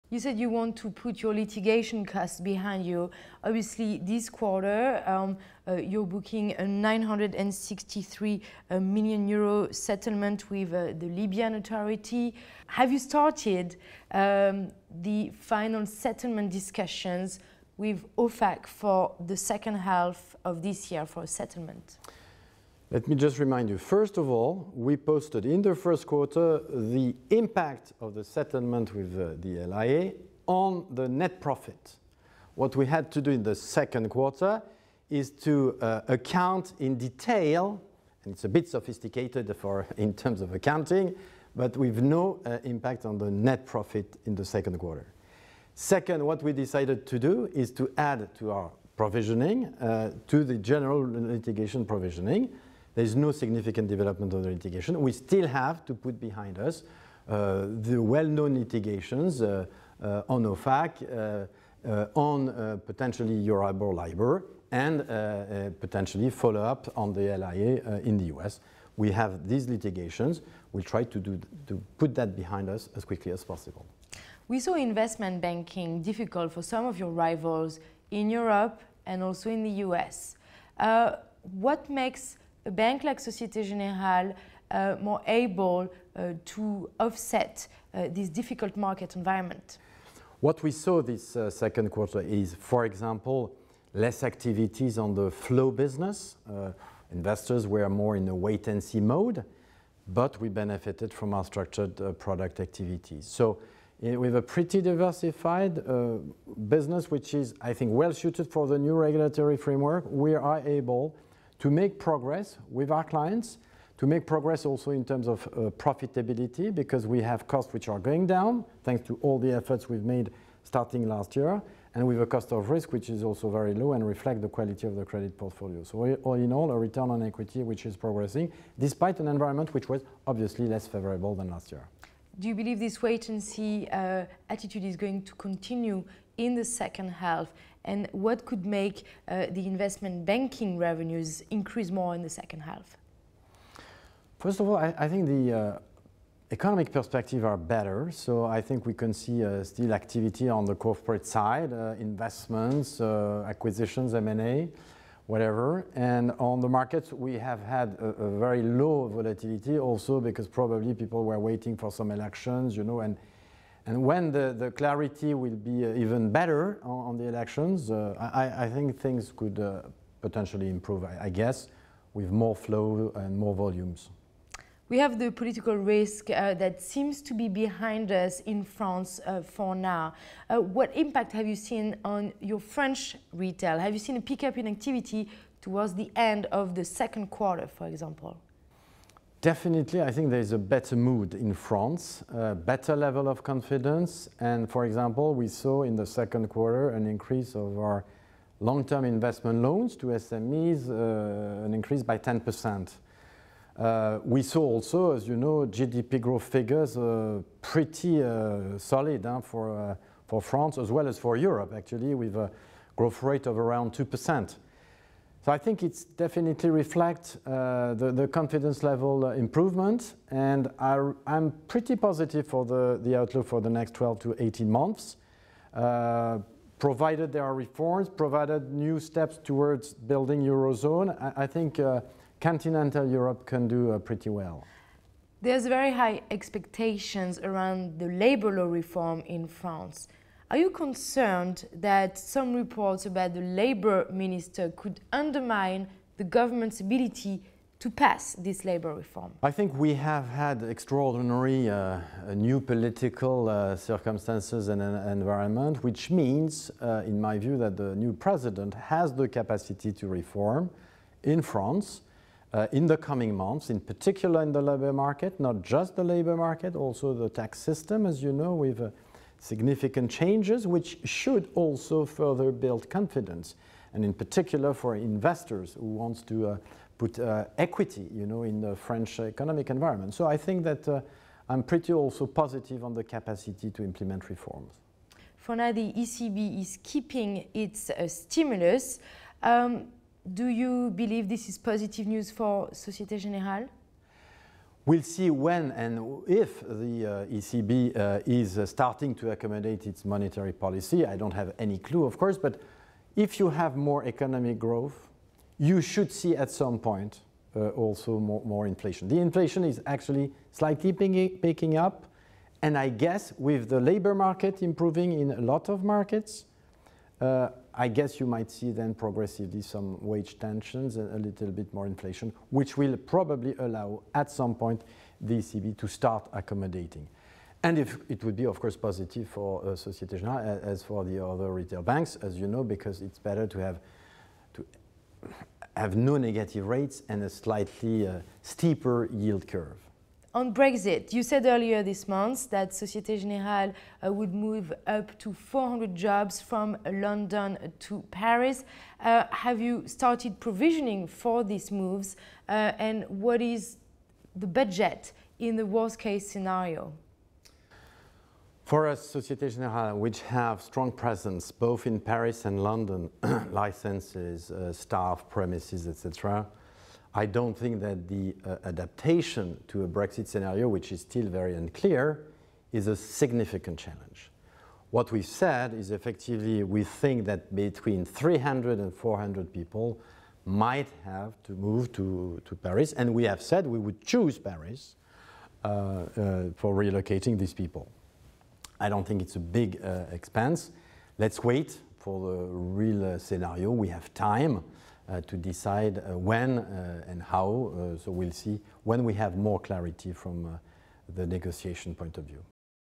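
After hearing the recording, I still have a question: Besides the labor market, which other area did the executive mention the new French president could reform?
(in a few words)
the tax system.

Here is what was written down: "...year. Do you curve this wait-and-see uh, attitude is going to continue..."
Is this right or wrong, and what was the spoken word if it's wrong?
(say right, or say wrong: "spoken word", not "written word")
wrong: "believe", not "curve".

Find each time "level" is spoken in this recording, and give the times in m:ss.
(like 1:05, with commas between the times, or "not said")
3:12, 3:38.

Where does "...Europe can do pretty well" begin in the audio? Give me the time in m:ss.
3:53.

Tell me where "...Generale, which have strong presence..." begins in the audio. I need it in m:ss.
5:59.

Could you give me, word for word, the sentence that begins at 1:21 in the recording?
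what makes a bank like Societe Generale uh, more able uh, to offset uh, this difficult market environment?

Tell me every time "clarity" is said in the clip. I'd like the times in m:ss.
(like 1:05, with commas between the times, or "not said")
2:44, 6:39.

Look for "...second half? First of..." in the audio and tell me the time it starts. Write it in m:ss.
2:22.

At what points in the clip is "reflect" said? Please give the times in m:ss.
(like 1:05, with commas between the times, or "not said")
2:04, 3:36.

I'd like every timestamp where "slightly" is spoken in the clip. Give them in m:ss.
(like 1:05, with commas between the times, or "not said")
5:10, 5:37.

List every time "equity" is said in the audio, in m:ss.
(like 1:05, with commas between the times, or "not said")
2:07, 4:37.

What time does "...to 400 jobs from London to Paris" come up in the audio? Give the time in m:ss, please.
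5:45.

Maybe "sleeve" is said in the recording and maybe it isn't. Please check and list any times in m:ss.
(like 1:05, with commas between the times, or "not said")
not said.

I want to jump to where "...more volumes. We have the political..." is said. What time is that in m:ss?
2:53.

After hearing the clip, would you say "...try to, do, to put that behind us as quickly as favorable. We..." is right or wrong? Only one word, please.
wrong.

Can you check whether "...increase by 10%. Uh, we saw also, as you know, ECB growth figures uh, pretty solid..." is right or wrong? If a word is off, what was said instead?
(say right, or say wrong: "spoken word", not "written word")
wrong: "GDP", not "ECB".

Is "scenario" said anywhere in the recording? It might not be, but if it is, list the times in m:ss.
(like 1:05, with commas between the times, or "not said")
5:56, 6:10, 6:33.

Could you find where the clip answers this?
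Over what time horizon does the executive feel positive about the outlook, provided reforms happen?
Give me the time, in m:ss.
3:43.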